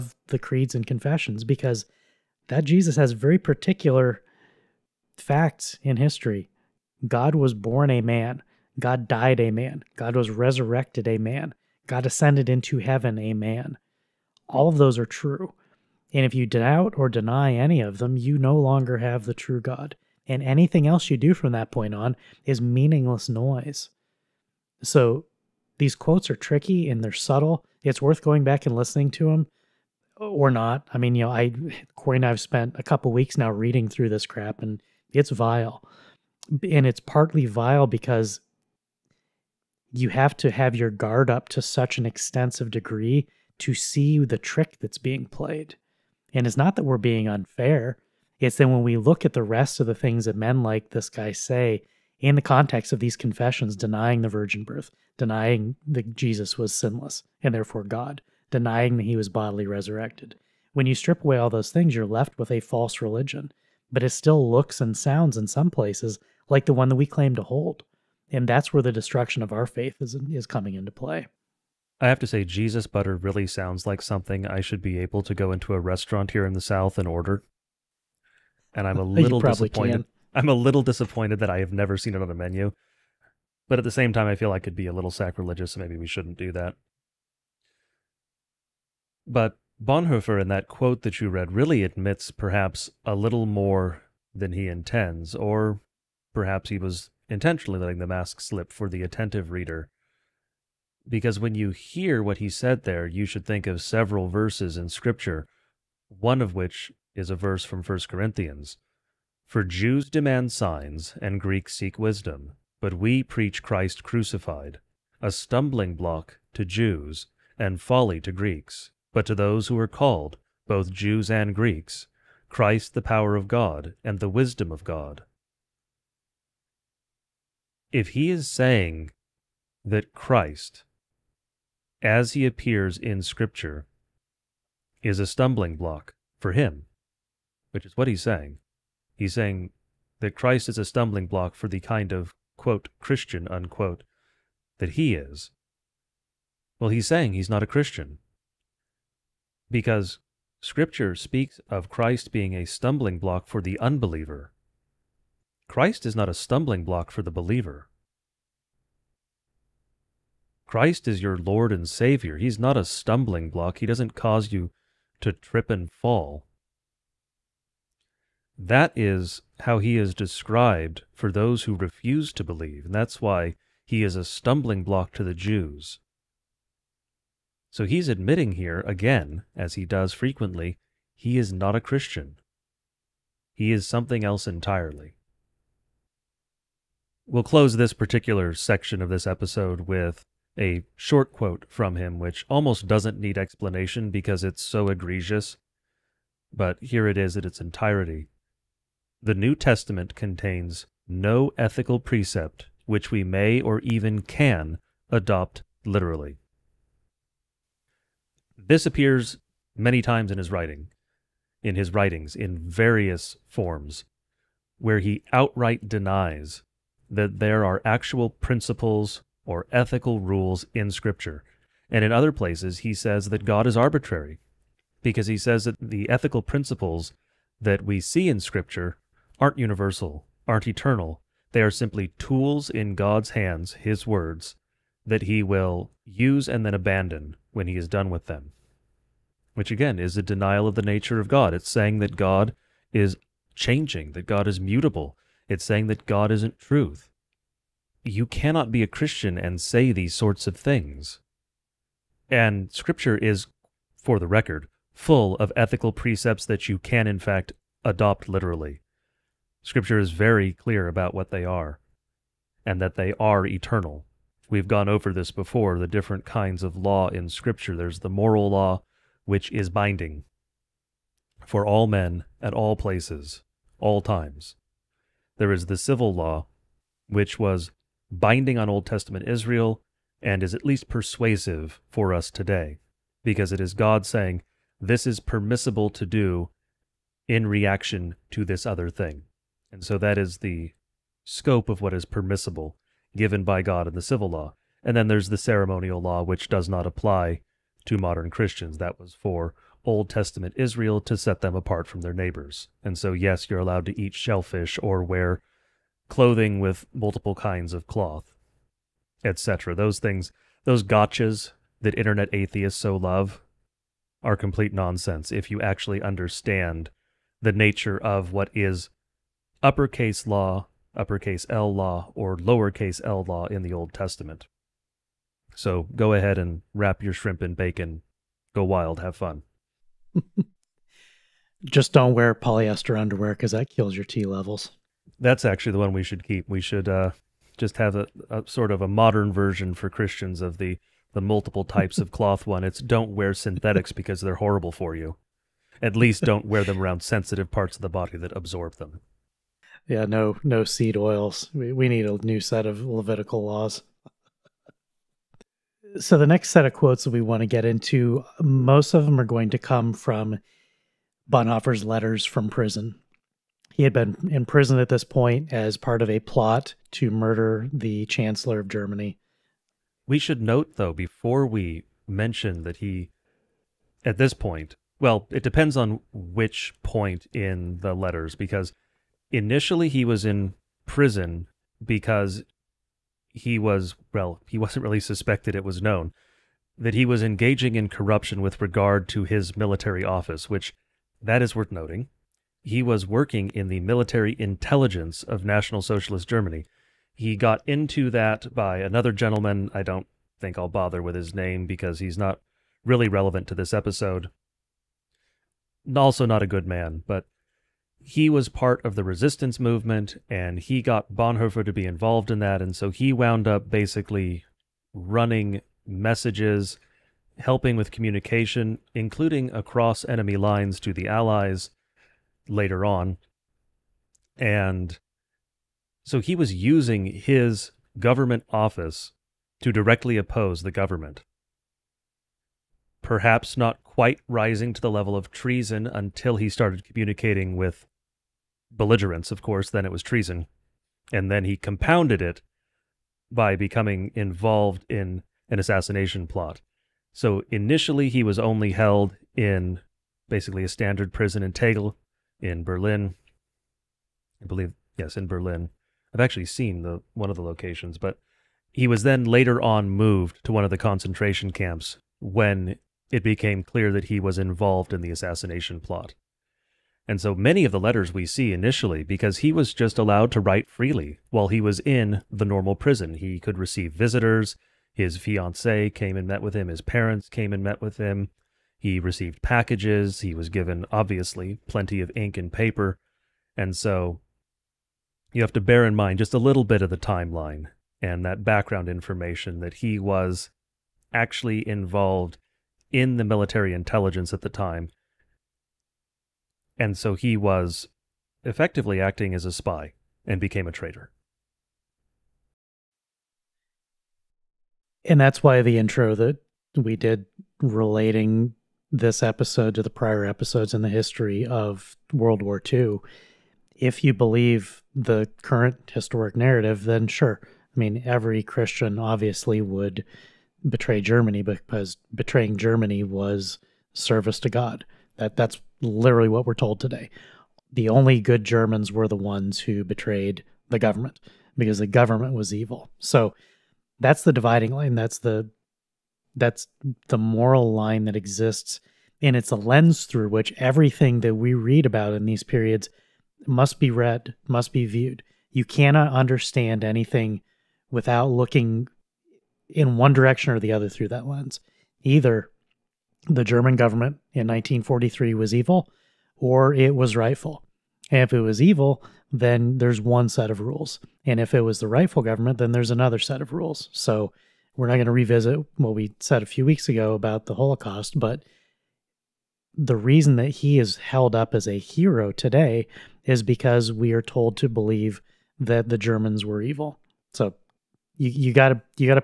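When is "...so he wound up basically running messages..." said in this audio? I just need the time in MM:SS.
06:52.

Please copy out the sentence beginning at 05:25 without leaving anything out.
So go ahead and wrap your shrimp in bacon.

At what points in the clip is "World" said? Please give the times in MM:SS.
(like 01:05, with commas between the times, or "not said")
08:32.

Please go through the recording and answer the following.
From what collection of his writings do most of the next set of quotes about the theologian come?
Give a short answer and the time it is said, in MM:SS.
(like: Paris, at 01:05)
Letters from prison, at 06:01.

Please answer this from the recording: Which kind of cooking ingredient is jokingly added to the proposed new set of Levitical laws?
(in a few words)
Seed oils.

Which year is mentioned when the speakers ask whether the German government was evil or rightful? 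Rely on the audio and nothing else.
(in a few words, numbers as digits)
1943.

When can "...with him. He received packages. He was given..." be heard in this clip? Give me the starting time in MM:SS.
07:57.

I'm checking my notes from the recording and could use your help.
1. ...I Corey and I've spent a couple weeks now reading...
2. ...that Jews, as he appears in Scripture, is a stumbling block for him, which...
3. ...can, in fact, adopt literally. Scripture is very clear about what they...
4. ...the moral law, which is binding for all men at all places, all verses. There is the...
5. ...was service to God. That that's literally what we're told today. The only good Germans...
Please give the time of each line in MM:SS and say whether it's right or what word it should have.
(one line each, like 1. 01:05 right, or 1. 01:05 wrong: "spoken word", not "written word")
1. 00:31 right
2. 02:09 wrong: "Christ", not "Jews"
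3. 04:16 right
4. 04:27 wrong: "times", not "verses"
5. 08:43 right.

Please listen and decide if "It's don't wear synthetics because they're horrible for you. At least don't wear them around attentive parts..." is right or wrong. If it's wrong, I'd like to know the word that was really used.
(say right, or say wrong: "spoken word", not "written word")
wrong: "sensitive", not "attentive".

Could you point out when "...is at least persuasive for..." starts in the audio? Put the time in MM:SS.
04:40.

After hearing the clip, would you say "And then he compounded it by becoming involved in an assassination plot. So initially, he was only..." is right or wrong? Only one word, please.
right.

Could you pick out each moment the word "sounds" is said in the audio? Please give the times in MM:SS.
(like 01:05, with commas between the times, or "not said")
01:04, 01:13.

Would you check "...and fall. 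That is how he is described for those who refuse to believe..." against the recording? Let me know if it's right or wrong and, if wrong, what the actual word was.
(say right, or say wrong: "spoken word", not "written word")
right.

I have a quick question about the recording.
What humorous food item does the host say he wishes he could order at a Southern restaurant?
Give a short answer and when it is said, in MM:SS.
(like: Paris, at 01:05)
Jesus butter, at 01:12.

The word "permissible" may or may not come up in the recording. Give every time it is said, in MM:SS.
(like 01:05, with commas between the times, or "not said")
04:45, 04:52.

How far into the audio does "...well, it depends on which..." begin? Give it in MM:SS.
06:14.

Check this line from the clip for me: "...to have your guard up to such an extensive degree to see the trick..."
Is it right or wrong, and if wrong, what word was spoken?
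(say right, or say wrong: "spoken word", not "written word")
right.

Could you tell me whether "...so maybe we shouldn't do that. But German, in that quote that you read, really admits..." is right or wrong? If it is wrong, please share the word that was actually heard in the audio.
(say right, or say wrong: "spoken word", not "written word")
wrong: "Bonhoeffer", not "German".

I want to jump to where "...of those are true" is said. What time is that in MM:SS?
00:14.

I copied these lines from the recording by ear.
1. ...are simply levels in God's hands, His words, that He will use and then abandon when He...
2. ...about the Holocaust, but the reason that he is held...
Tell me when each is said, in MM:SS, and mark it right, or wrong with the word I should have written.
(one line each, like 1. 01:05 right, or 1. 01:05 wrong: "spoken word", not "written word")
1. 03:51 wrong: "tools", not "levels"
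2. 09:27 right.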